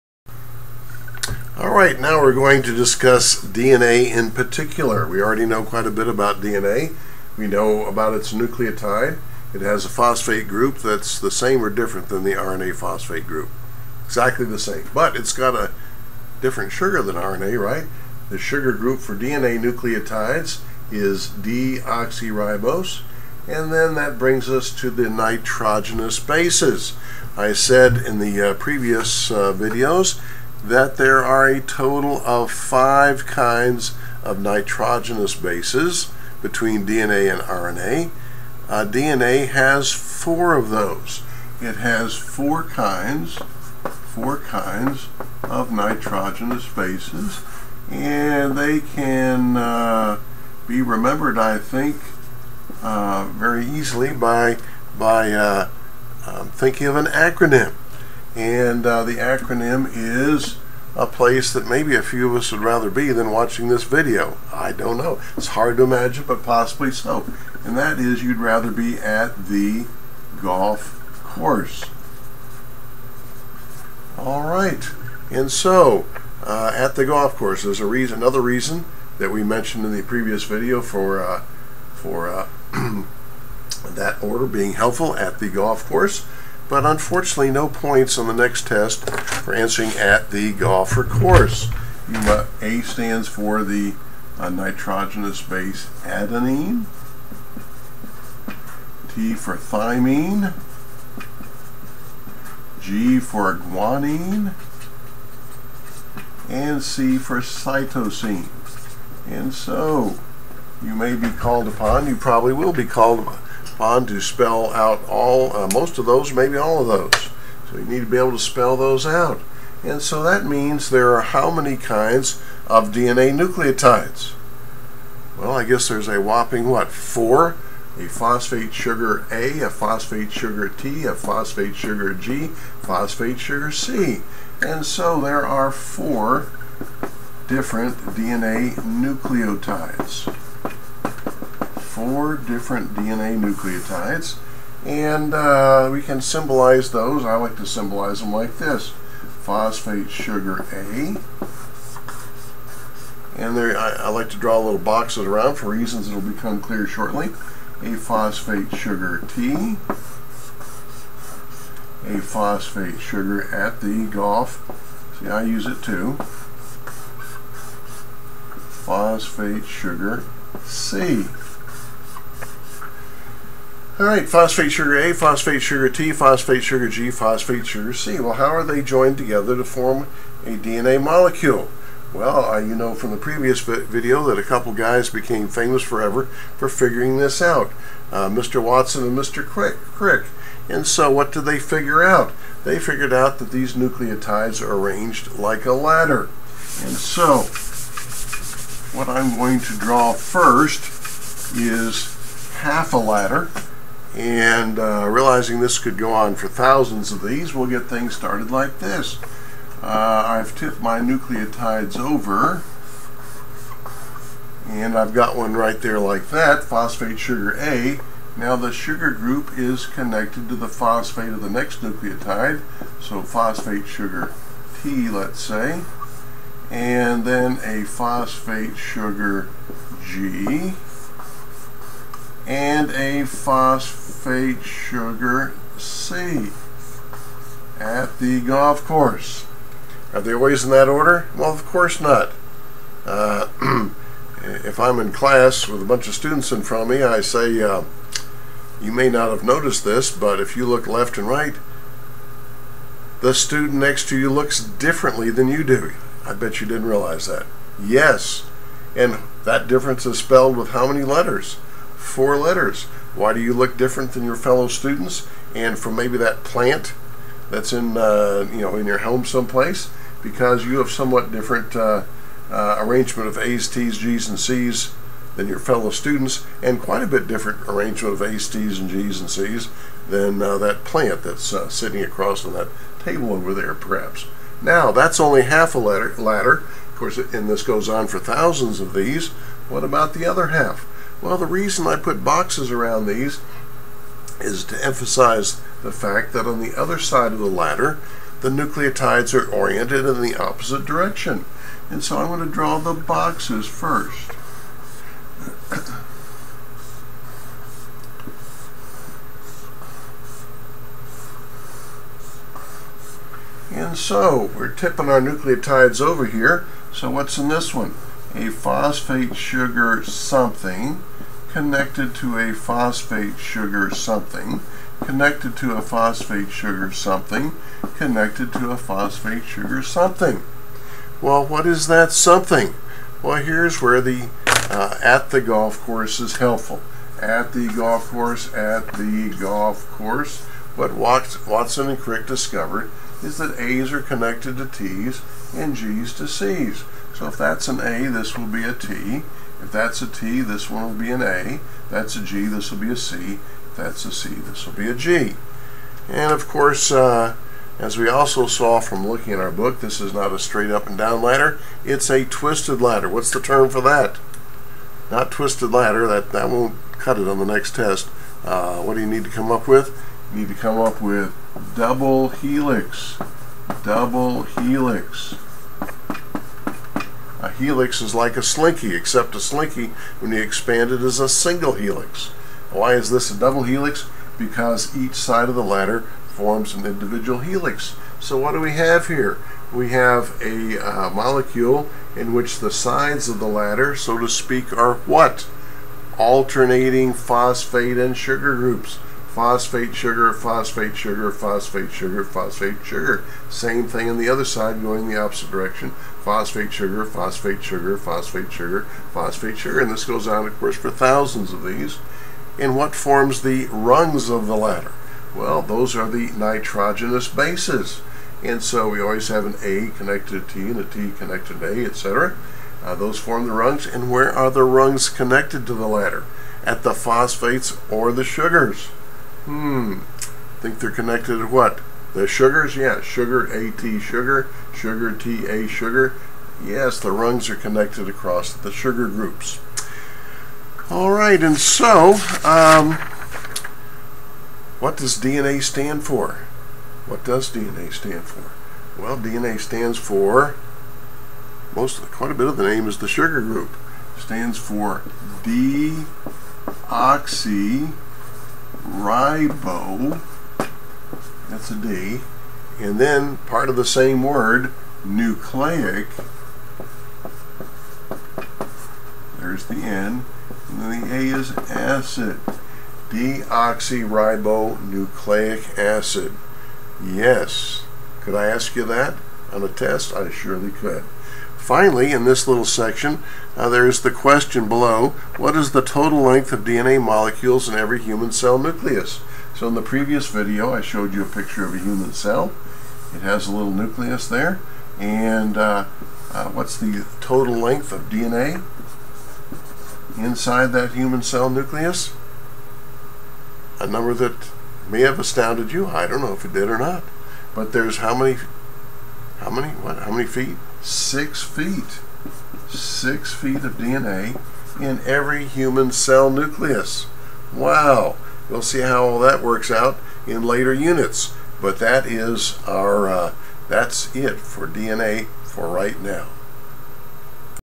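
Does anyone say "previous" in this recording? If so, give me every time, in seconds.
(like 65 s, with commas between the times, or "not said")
28 s, 80 s, 183 s, 489 s.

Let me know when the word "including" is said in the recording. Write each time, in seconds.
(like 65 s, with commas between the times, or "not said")
not said.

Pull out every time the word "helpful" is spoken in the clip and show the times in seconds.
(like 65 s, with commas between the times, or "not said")
84 s, 336 s.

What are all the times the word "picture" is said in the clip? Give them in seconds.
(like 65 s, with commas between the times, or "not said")
491 s.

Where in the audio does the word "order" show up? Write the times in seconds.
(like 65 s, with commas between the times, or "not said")
84 s, 240 s.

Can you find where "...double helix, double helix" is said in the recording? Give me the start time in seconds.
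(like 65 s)
371 s.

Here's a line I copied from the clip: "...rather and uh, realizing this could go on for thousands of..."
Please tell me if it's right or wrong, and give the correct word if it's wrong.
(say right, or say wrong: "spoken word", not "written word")
wrong: "ladder", not "rather".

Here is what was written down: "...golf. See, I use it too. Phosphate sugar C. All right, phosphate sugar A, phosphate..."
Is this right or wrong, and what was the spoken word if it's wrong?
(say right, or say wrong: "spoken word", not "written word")
right.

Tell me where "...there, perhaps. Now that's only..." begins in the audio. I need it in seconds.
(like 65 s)
283 s.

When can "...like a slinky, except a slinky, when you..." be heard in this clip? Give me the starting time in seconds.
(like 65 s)
378 s.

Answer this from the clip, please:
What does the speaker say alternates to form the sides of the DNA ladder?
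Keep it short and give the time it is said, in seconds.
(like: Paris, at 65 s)
phosphate and sugar groups, at 396 s.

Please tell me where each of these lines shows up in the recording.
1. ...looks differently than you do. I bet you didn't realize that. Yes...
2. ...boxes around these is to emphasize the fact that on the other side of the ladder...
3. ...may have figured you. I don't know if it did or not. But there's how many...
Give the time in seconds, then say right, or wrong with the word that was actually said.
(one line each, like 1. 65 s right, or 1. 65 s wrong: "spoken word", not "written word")
1. 254 s right
2. 292 s right
3. 504 s wrong: "astounded", not "figured".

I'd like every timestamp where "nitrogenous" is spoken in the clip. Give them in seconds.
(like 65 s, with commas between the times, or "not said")
25 s, 34 s, 45 s, 94 s, 416 s.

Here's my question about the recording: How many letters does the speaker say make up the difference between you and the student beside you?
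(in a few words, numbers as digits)
4.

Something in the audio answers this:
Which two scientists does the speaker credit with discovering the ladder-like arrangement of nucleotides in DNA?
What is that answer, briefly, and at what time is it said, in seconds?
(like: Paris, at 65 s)
Watson and Crick, at 188 s.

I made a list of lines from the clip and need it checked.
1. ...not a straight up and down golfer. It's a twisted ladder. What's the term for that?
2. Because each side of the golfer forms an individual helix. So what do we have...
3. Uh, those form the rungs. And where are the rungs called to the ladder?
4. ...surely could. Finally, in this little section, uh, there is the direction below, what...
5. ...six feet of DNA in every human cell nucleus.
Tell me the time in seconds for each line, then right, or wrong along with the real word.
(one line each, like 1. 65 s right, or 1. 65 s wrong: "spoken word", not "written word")
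1. 360 s wrong: "ladder", not "golfer"
2. 384 s wrong: "ladder", not "golfer"
3. 422 s wrong: "connected", not "called"
4. 480 s wrong: "question", not "direction"
5. 512 s right.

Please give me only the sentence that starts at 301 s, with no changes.
And so I'm going to draw the boxes first.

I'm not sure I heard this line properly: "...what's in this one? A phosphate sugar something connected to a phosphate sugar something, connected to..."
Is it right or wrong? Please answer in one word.
right.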